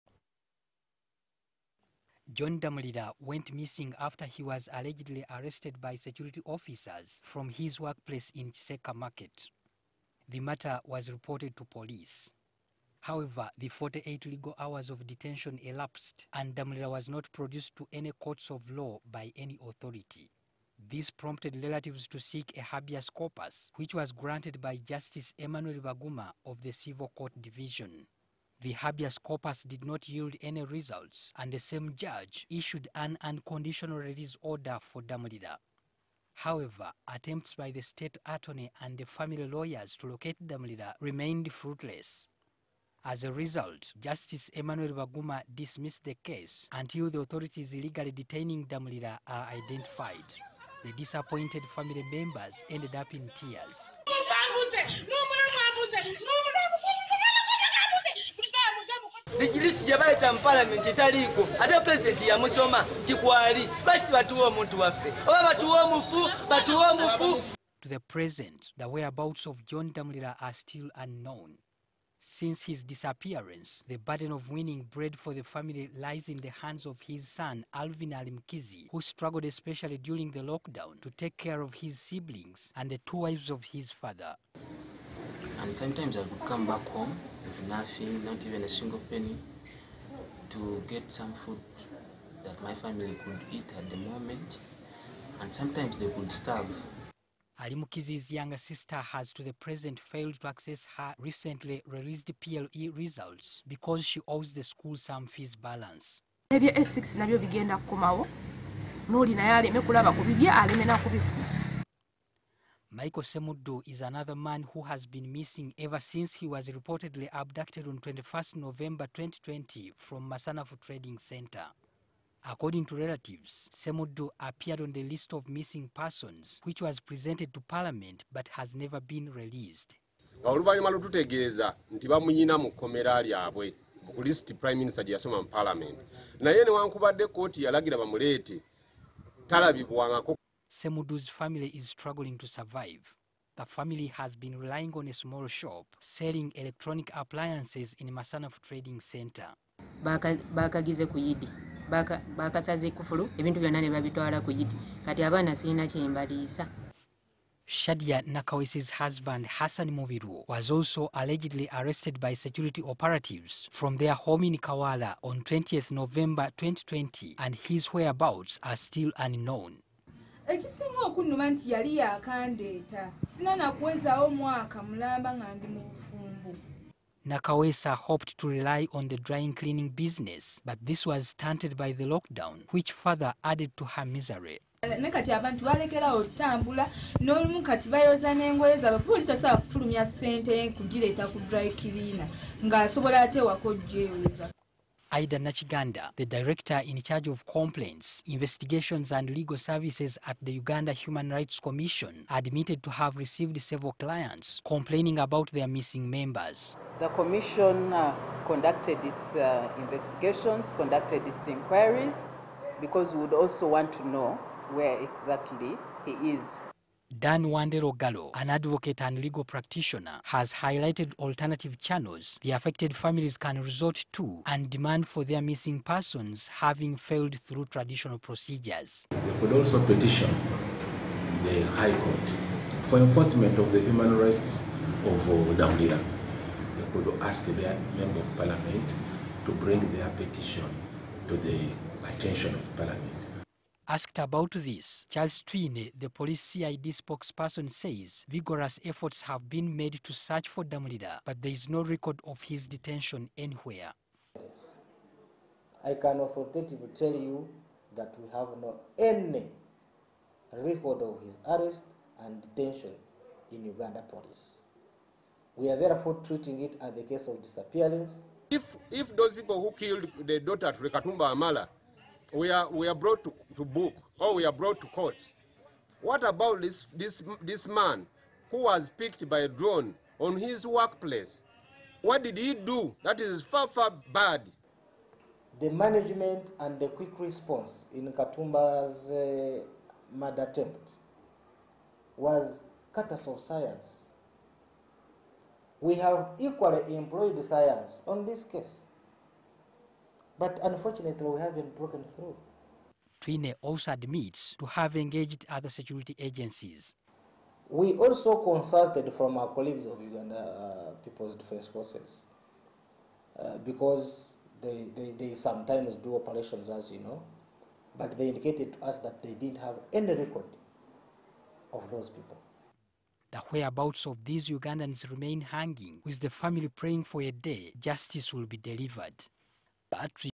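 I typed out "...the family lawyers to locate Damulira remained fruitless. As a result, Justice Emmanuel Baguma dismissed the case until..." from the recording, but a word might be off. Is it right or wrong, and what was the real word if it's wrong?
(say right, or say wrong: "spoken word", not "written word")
right.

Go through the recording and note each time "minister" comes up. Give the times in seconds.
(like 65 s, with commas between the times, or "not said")
134 s.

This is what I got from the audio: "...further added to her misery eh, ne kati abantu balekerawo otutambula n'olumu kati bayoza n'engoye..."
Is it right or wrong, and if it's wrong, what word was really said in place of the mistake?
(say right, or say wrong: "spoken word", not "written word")
right.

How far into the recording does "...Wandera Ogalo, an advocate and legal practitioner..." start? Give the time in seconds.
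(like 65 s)
217 s.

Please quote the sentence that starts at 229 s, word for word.
They could also petition the High Court for enforcement of the human rights of uh, Damulira.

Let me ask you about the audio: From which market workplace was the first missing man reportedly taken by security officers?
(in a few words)
Kiseka Market.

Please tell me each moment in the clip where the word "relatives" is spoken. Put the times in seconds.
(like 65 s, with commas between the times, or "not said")
21 s, 122 s.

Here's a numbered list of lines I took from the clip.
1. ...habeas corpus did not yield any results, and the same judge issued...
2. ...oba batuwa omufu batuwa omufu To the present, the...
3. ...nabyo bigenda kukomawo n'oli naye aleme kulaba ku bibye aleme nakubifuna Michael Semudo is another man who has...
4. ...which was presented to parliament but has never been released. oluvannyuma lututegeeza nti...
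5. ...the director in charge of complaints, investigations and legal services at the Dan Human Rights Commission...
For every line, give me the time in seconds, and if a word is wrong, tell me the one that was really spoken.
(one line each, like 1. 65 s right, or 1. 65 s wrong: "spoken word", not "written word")
1. 28 s right
2. 65 s right
3. 107 s right
4. 126 s right
5. 196 s wrong: "Uganda", not "Dan".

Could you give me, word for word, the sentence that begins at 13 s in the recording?
However, the 48 legal hours of detention elapsed and Damulira was not produced to any courts of law by any authority.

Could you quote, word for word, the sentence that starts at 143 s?
The family has been relying on a small shop selling electronic appliances in Masanafu Trading Center.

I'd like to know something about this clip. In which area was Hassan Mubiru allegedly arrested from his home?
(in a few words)
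Kawala.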